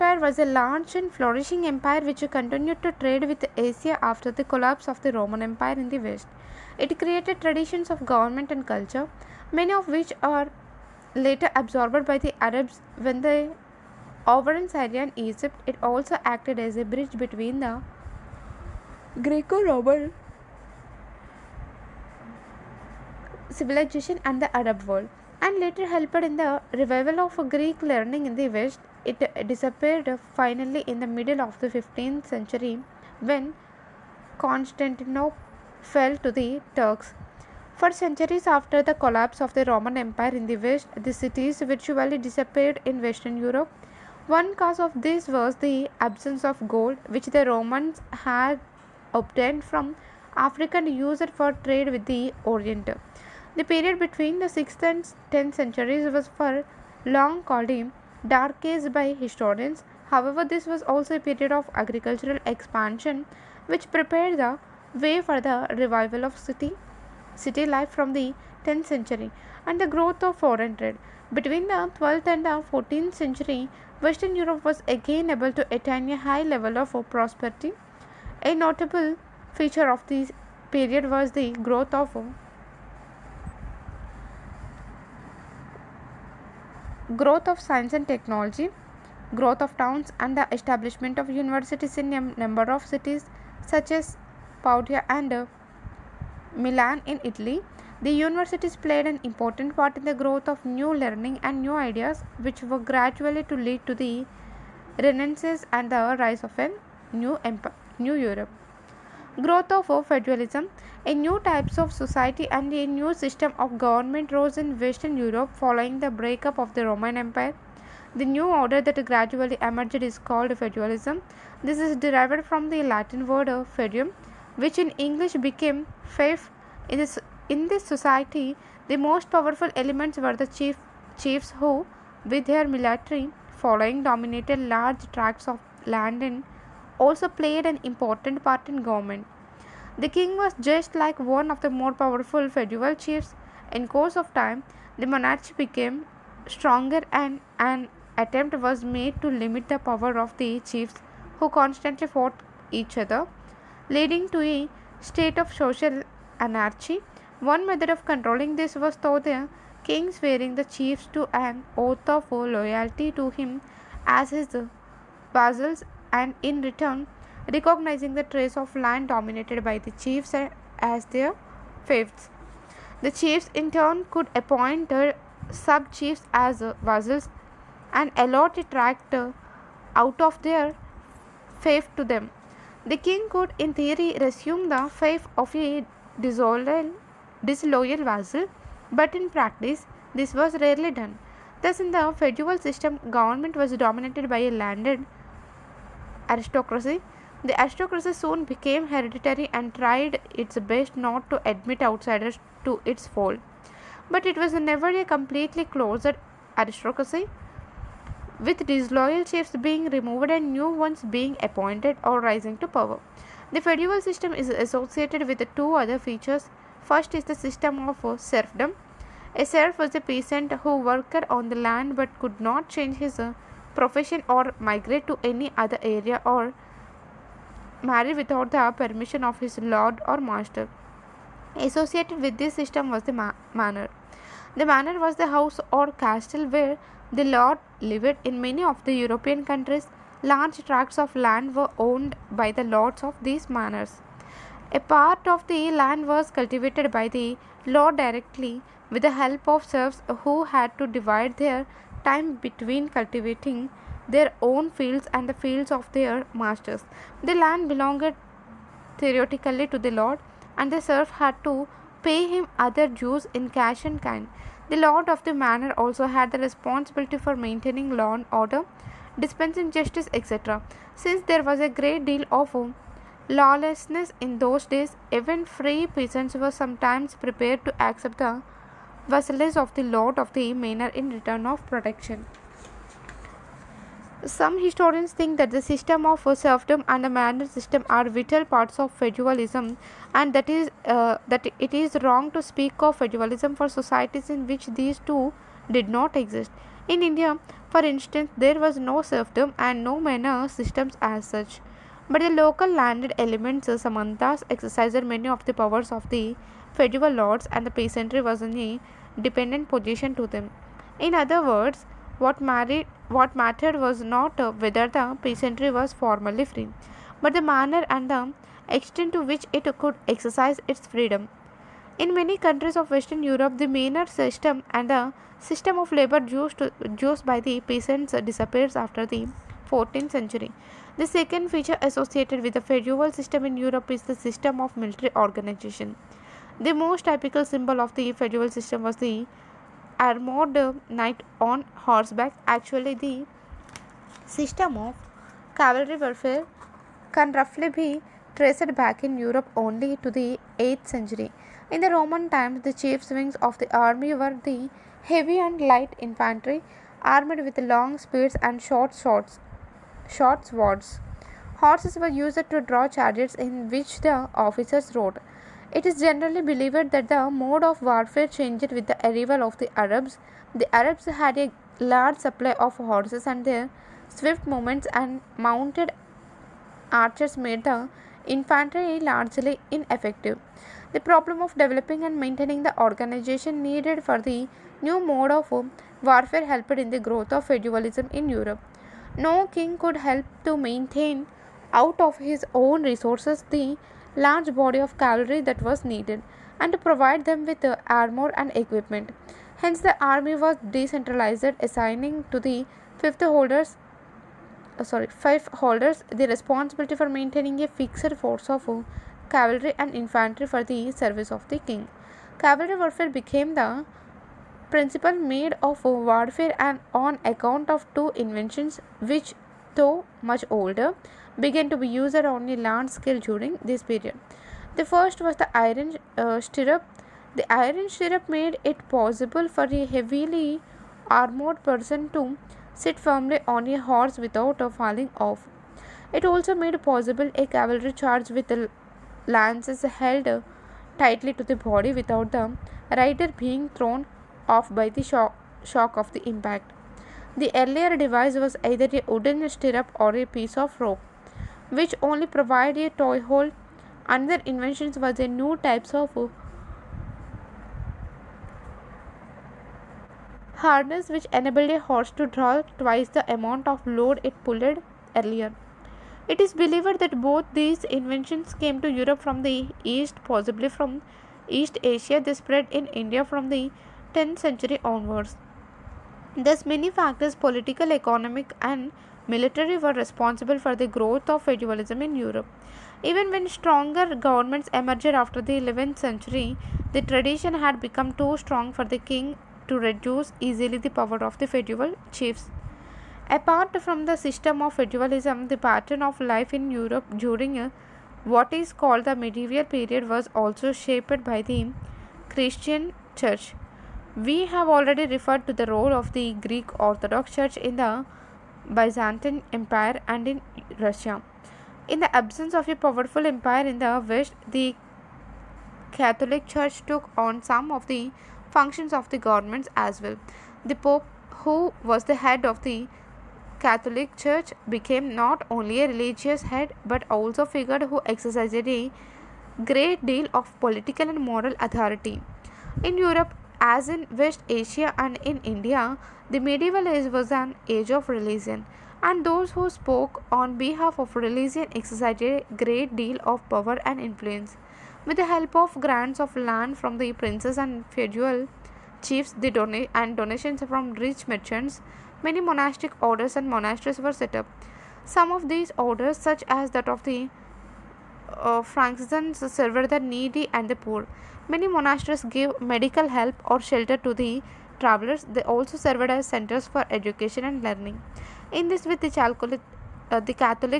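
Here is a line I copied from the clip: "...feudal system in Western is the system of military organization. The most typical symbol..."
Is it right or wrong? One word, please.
wrong.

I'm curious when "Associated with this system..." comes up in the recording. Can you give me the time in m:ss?
3:51.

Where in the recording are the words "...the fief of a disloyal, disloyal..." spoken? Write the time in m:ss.
3:04.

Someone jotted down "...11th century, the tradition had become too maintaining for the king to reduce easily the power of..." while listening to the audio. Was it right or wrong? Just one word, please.
wrong.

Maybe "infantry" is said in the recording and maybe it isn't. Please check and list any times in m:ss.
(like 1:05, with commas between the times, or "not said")
5:55, 6:18, 6:49.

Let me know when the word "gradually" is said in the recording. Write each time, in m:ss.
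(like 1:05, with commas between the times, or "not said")
1:42, 1:59.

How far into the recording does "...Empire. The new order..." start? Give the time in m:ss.
1:57.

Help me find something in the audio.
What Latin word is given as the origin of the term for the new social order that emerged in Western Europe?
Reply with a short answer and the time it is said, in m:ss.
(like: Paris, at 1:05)
federum, at 2:03.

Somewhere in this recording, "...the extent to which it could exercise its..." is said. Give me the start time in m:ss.
5:18.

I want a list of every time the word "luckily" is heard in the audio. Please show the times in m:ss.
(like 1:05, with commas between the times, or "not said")
not said.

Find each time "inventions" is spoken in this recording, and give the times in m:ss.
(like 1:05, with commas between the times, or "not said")
6:58, 7:34, 7:47.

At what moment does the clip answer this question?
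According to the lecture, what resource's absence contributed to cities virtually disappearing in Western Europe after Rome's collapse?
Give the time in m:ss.
0:46.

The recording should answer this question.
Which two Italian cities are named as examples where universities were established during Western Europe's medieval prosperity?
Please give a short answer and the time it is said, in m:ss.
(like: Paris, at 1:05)
Padua and Milan, at 1:34.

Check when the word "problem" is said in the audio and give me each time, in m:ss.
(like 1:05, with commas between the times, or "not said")
6:21.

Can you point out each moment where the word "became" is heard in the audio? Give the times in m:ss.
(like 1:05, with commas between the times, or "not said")
2:05, 2:25, 3:18, 6:53, 8:44.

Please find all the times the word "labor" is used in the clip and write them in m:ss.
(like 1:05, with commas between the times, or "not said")
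5:25.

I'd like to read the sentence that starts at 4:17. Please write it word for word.
The land belonged theoretically to the lord, and the serf had to pay him other dues in cash and kind.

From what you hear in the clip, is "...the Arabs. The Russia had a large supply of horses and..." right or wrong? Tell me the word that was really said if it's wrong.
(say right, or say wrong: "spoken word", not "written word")
wrong: "Arabs", not "Russia".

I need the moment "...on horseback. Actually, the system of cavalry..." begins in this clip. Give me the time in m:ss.
5:41.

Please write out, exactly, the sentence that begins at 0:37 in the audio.
For centuries after the collapse of the Roman Empire in the West, the cities virtually disappeared in Western Europe.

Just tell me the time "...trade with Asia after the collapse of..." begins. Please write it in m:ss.
0:02.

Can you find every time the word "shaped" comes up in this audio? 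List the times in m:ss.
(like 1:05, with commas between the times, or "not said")
8:20.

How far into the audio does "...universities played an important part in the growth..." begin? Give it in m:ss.
1:38.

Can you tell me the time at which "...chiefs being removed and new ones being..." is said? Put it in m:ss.
3:29.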